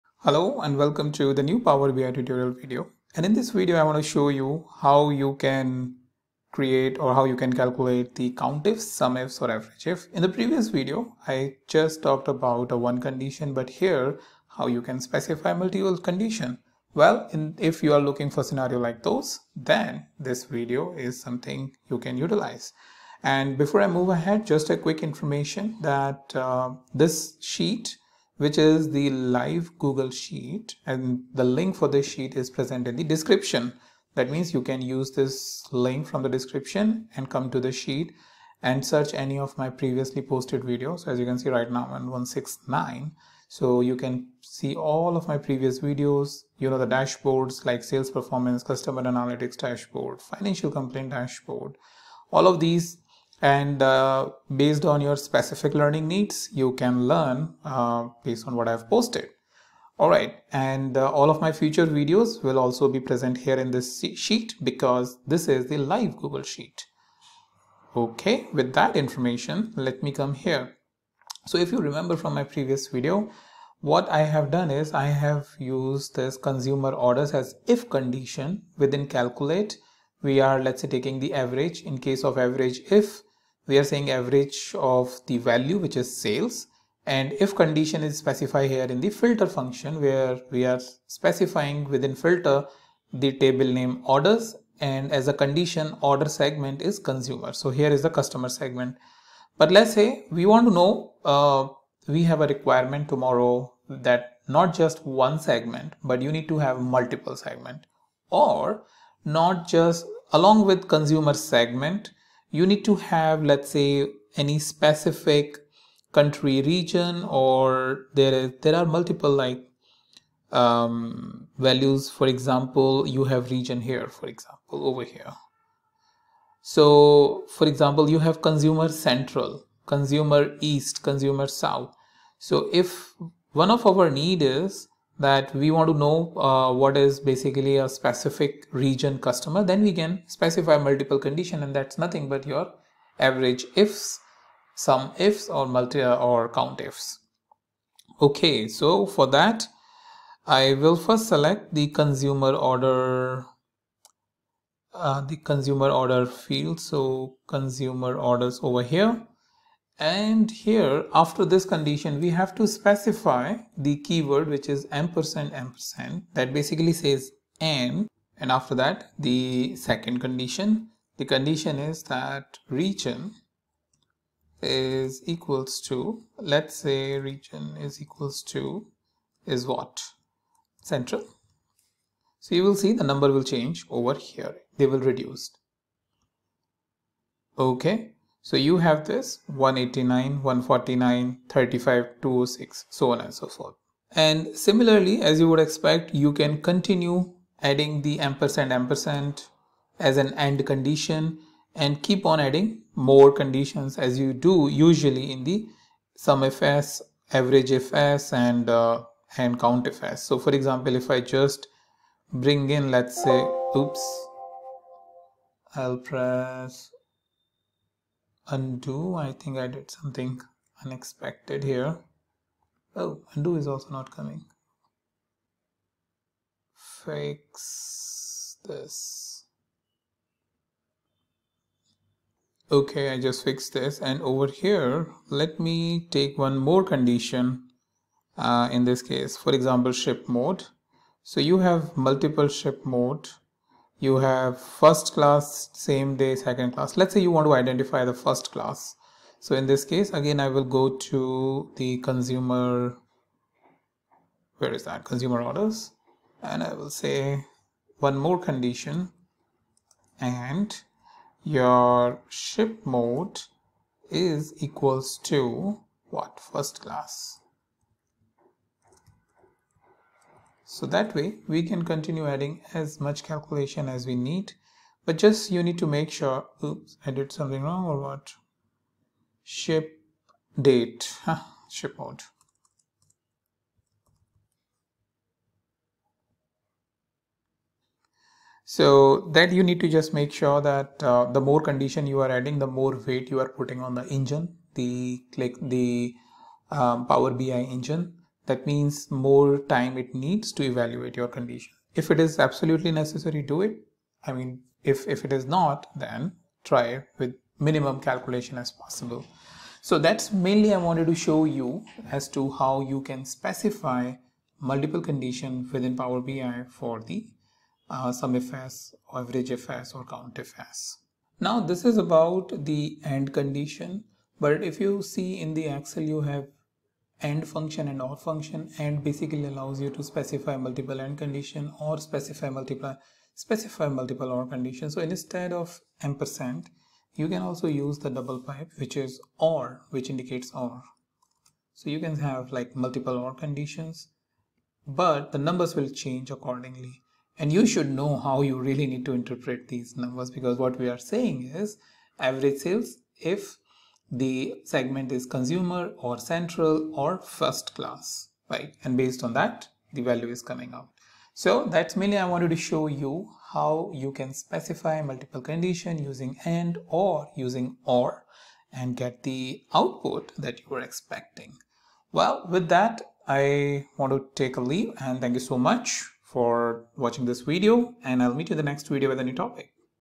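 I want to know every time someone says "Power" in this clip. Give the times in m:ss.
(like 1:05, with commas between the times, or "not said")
0:01, 4:57, 5:15.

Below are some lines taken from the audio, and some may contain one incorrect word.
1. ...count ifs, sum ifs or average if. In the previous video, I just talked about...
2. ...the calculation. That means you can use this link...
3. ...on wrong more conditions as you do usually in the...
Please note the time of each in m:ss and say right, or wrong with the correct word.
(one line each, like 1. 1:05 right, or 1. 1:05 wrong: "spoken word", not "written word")
1. 0:08 right
2. 0:32 wrong: "description", not "calculation"
3. 3:22 wrong: "adding", not "wrong".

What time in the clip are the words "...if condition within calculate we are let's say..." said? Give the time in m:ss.
1:17.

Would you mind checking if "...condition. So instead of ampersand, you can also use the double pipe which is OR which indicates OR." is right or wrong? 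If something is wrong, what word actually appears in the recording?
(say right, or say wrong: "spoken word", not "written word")
right.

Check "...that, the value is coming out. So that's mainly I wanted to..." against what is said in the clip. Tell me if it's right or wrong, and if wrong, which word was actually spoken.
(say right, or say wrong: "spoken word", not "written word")
right.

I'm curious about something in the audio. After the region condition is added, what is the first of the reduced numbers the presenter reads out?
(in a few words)
189.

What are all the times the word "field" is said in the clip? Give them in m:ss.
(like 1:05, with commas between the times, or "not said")
2:36.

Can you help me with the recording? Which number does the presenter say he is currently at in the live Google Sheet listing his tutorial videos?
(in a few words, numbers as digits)
169.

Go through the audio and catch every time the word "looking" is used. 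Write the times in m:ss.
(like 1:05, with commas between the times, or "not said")
0:17.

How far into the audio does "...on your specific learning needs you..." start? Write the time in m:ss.
0:54.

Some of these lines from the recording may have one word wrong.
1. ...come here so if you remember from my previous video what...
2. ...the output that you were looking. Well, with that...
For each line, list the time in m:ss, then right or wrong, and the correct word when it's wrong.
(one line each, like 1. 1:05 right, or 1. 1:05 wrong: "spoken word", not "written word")
1. 1:10 right
2. 6:09 wrong: "expecting", not "looking".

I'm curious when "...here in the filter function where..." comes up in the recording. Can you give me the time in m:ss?
1:28.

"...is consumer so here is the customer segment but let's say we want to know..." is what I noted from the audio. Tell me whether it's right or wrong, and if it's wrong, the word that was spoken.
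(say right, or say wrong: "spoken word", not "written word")
right.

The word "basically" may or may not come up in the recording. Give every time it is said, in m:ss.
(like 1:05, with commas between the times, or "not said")
2:17, 2:46, 5:29.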